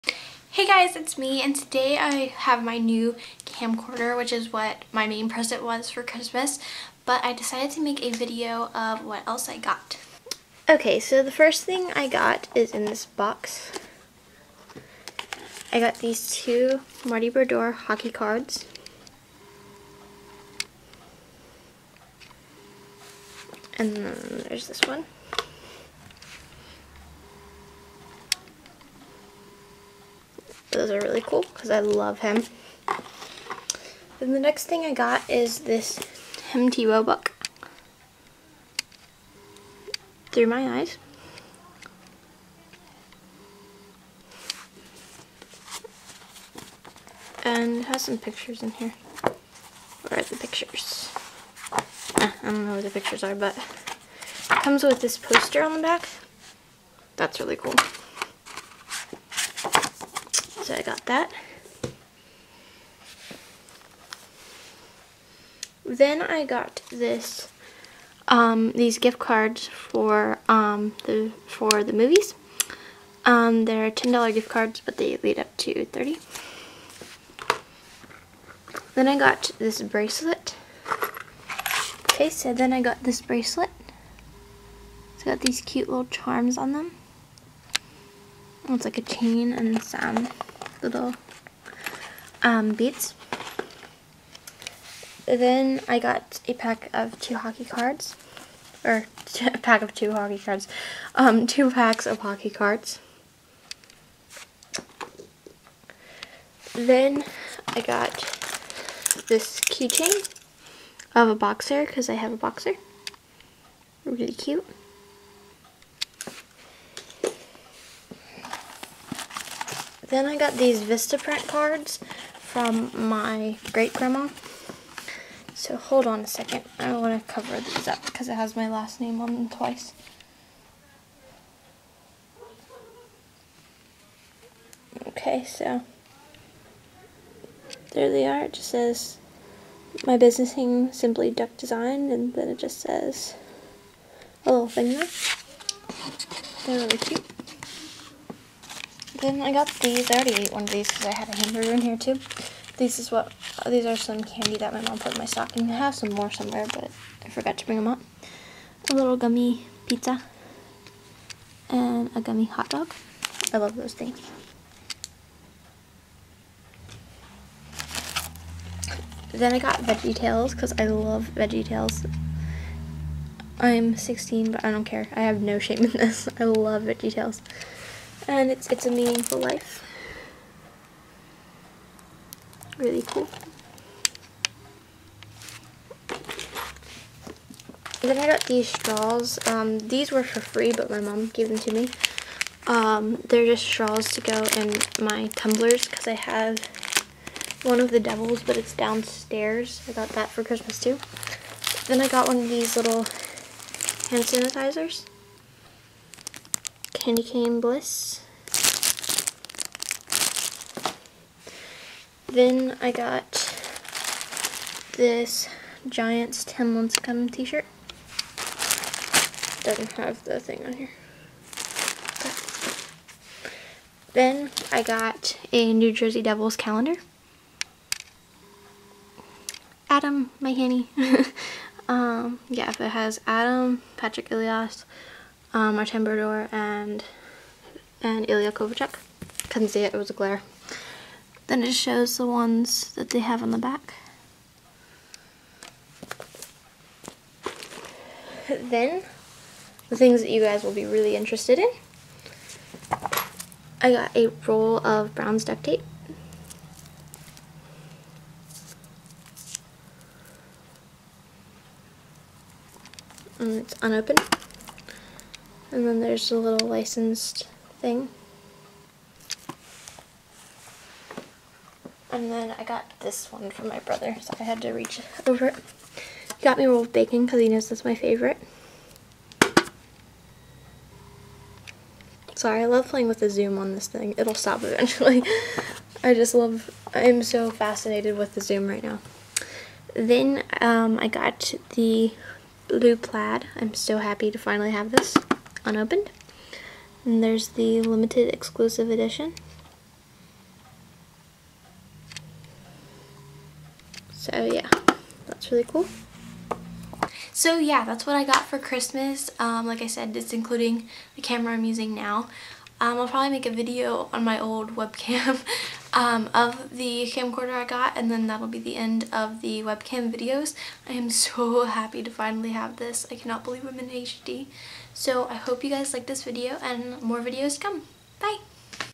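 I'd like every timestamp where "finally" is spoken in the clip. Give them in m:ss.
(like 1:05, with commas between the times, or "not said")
4:54, 5:22.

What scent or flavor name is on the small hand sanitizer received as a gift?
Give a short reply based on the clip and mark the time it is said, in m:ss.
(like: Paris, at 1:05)
Candy Cane Bliss, at 3:26.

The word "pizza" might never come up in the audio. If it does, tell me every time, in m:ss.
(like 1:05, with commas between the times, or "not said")
2:39.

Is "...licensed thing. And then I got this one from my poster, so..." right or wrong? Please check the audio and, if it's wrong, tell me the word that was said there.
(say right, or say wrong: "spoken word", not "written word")
wrong: "brother", not "poster".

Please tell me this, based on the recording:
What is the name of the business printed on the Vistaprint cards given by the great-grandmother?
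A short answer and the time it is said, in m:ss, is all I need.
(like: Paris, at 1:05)
Simply Duck Design, at 2:20.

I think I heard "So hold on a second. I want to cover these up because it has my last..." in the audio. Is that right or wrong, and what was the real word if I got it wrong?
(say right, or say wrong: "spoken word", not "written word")
right.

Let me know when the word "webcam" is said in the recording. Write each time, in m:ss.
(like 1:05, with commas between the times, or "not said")
5:14, 5:19.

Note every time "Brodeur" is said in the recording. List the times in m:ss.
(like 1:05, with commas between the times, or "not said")
0:17, 3:56.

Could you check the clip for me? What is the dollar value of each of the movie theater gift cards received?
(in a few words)
$10.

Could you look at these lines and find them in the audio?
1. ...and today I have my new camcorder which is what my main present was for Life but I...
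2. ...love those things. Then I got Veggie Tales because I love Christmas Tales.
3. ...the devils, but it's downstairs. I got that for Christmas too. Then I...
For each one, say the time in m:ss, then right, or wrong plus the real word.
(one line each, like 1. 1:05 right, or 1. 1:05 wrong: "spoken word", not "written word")
1. 0:01 wrong: "Christmas", not "Life"
2. 2:43 wrong: "Veggie", not "Christmas"
3. 3:17 right.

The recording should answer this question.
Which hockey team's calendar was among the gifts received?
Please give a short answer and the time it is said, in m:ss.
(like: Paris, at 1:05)
New Jersey Devils, at 3:45.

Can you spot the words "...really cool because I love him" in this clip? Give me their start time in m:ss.
0:31.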